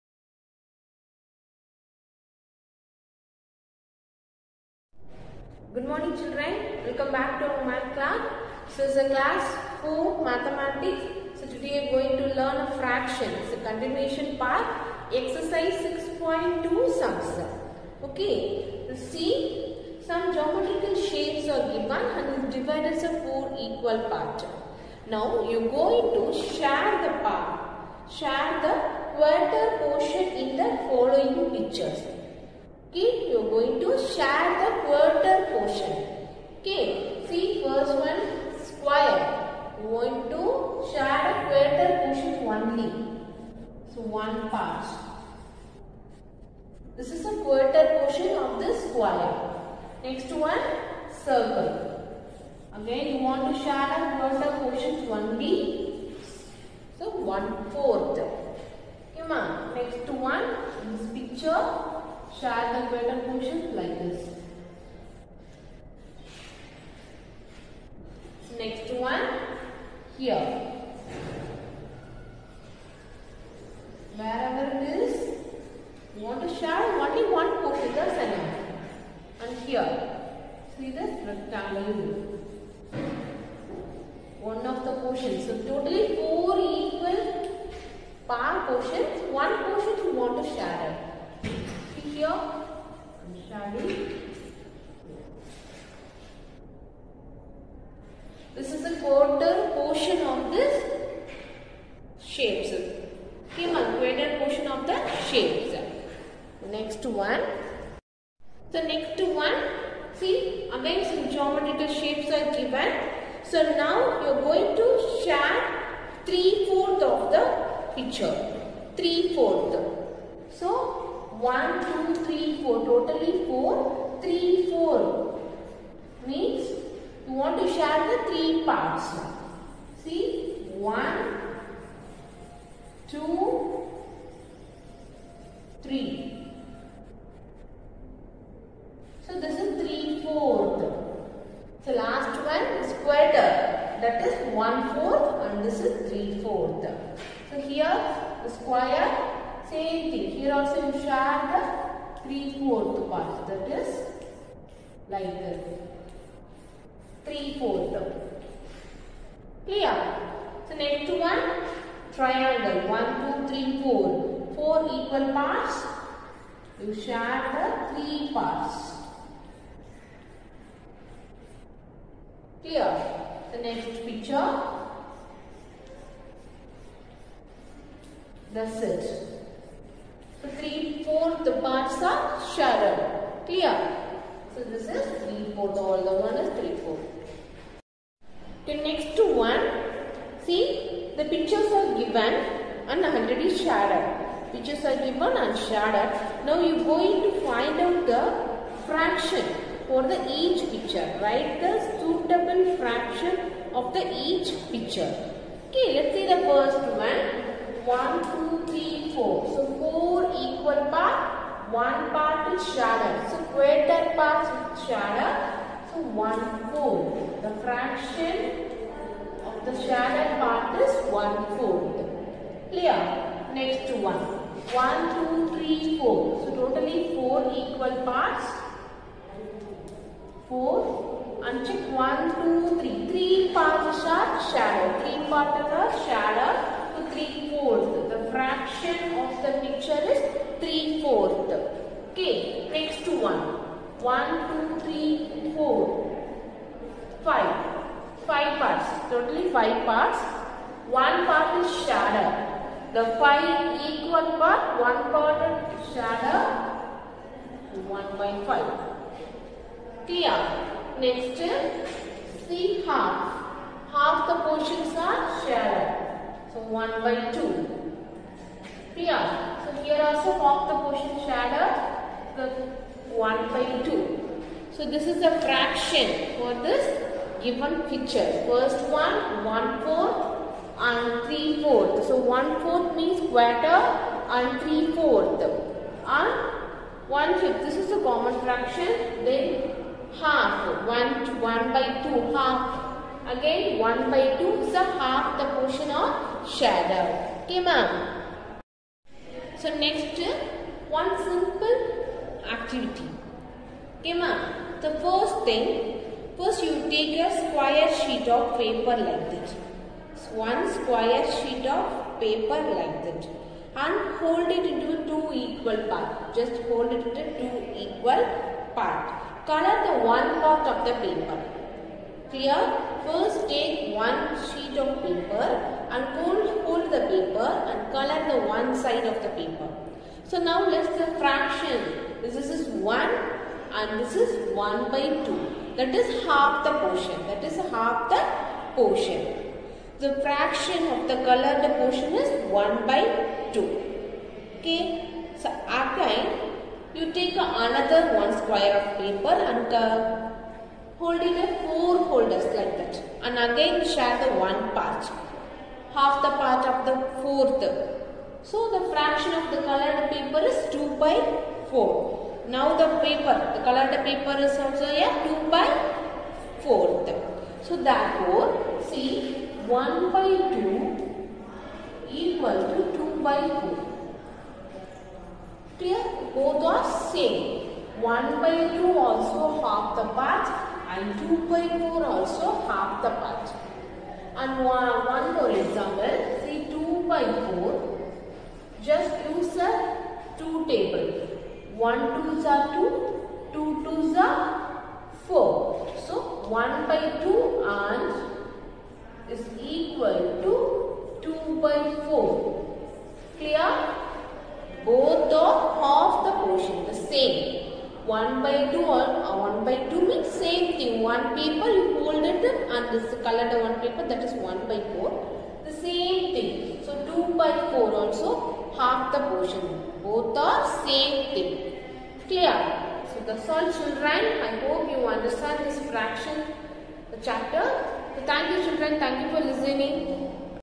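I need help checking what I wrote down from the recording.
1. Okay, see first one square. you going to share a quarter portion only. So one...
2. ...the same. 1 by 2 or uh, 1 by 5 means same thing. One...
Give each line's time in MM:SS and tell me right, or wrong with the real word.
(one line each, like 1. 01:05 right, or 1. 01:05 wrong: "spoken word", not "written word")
1. 00:36 right
2. 06:46 wrong: "2", not "5".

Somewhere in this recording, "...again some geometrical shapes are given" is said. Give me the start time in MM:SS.
01:50.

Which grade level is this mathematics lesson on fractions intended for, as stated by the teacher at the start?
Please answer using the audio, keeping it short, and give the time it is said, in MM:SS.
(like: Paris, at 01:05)
Class 4, at 00:09.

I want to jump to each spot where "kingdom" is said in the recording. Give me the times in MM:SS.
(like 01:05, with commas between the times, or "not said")
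not said.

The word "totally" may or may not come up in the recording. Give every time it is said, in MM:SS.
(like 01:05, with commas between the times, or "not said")
01:25, 02:02, 03:46, 04:09.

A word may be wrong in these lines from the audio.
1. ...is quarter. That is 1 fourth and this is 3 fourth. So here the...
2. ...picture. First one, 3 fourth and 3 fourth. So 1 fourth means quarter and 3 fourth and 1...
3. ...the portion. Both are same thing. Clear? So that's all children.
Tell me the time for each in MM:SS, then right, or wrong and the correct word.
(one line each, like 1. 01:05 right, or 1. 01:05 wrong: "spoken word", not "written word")
1. 02:22 right
2. 04:37 wrong: "1", not "3"
3. 06:59 right.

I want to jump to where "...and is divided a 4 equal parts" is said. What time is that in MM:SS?
00:22.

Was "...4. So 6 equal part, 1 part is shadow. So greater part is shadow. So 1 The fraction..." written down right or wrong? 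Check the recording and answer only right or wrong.
wrong.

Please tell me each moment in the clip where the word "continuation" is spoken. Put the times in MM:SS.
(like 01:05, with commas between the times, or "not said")
00:13.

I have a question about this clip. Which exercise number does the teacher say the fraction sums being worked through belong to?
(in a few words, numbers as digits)
6.2.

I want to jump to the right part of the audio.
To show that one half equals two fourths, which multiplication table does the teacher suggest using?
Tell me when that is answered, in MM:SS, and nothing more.
06:30.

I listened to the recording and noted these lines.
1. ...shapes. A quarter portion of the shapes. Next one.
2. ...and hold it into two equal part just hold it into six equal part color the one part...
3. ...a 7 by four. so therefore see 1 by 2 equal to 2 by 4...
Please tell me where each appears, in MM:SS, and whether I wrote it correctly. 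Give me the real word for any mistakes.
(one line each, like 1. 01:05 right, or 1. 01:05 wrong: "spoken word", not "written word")
1. 01:42 right
2. 05:13 wrong: "two", not "six"
3. 06:05 wrong: "2", not "7".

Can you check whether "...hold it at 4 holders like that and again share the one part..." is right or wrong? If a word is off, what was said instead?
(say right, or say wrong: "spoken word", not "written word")
right.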